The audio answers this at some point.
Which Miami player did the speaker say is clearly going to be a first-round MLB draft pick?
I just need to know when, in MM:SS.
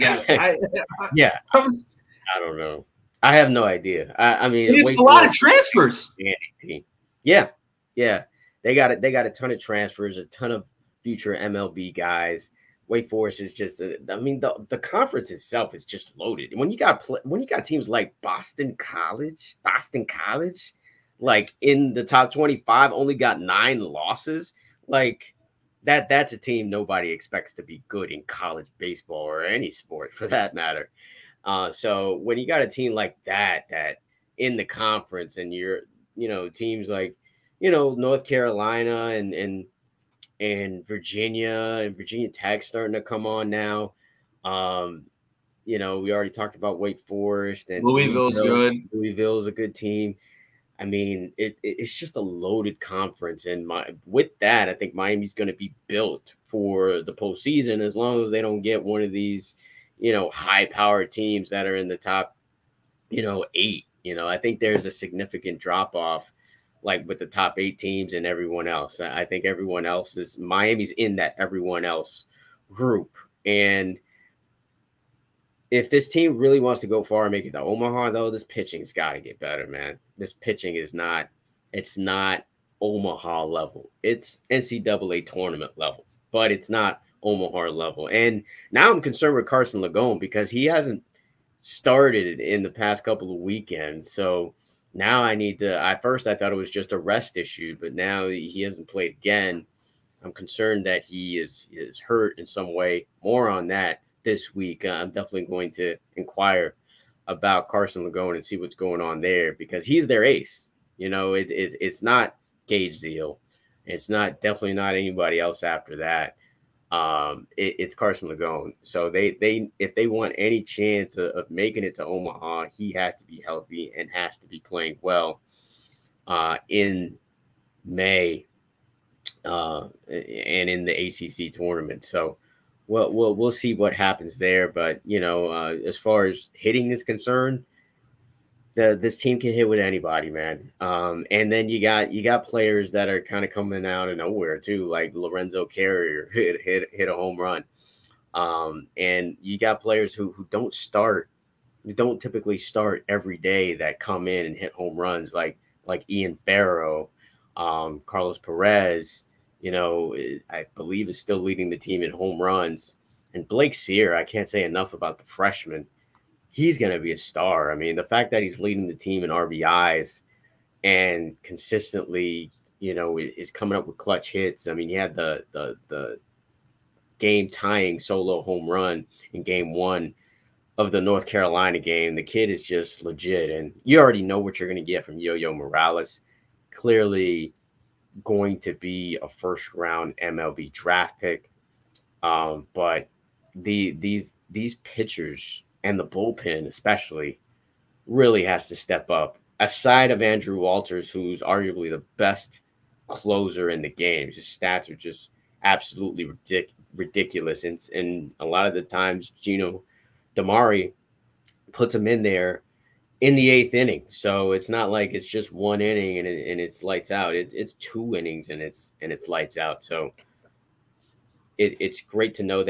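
03:05.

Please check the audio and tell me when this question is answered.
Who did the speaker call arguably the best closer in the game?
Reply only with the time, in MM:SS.
03:20.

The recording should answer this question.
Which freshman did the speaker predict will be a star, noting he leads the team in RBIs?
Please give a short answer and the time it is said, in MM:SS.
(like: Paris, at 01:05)
Blake Cyr, at 02:43.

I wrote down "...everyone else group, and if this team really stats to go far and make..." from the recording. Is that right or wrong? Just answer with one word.
wrong.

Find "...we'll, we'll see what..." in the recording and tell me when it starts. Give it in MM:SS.
02:13.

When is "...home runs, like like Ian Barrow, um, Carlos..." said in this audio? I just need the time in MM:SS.
02:34.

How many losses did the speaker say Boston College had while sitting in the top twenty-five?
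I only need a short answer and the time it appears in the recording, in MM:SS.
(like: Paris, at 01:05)
9, at 00:23.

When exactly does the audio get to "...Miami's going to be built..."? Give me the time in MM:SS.
00:54.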